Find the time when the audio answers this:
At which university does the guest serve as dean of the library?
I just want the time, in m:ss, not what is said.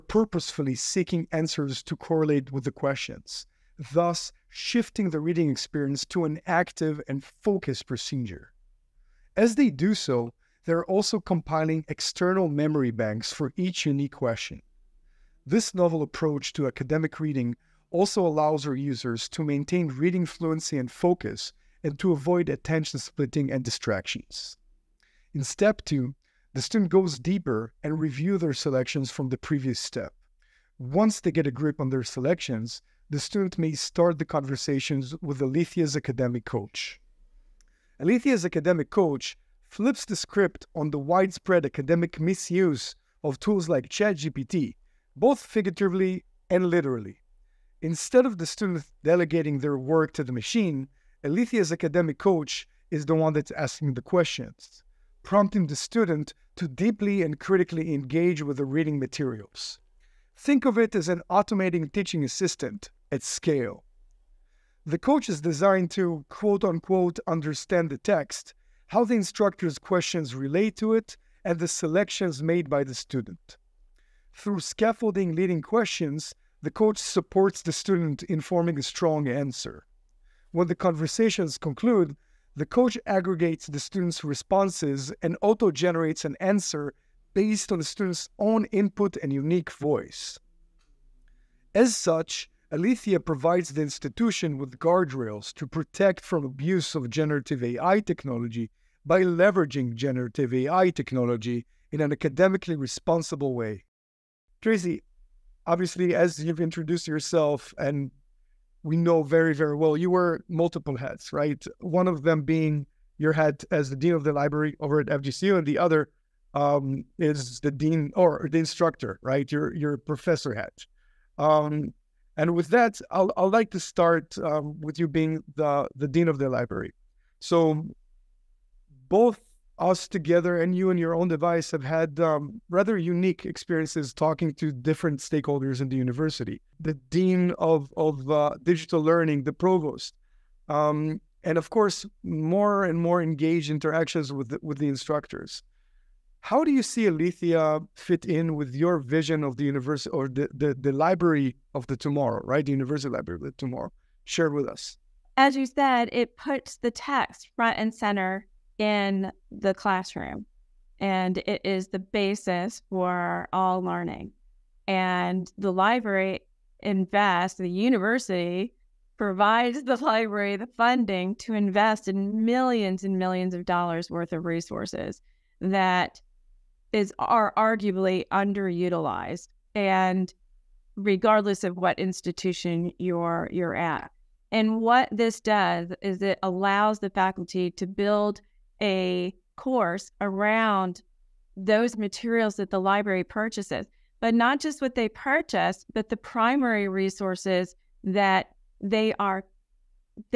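1:55.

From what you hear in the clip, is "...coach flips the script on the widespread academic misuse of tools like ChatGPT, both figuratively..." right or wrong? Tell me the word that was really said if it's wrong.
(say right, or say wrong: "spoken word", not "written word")
right.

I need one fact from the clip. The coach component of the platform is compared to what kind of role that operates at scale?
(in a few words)
teaching assistant.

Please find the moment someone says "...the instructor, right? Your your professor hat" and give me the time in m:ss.
1:58.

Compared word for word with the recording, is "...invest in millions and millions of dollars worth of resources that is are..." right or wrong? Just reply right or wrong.
right.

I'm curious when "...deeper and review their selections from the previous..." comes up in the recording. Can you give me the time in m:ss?
0:27.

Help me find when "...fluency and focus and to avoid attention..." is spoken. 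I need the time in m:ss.
0:20.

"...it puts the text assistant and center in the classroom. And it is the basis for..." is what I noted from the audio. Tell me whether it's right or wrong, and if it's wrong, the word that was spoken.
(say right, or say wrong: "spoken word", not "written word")
wrong: "front", not "assistant".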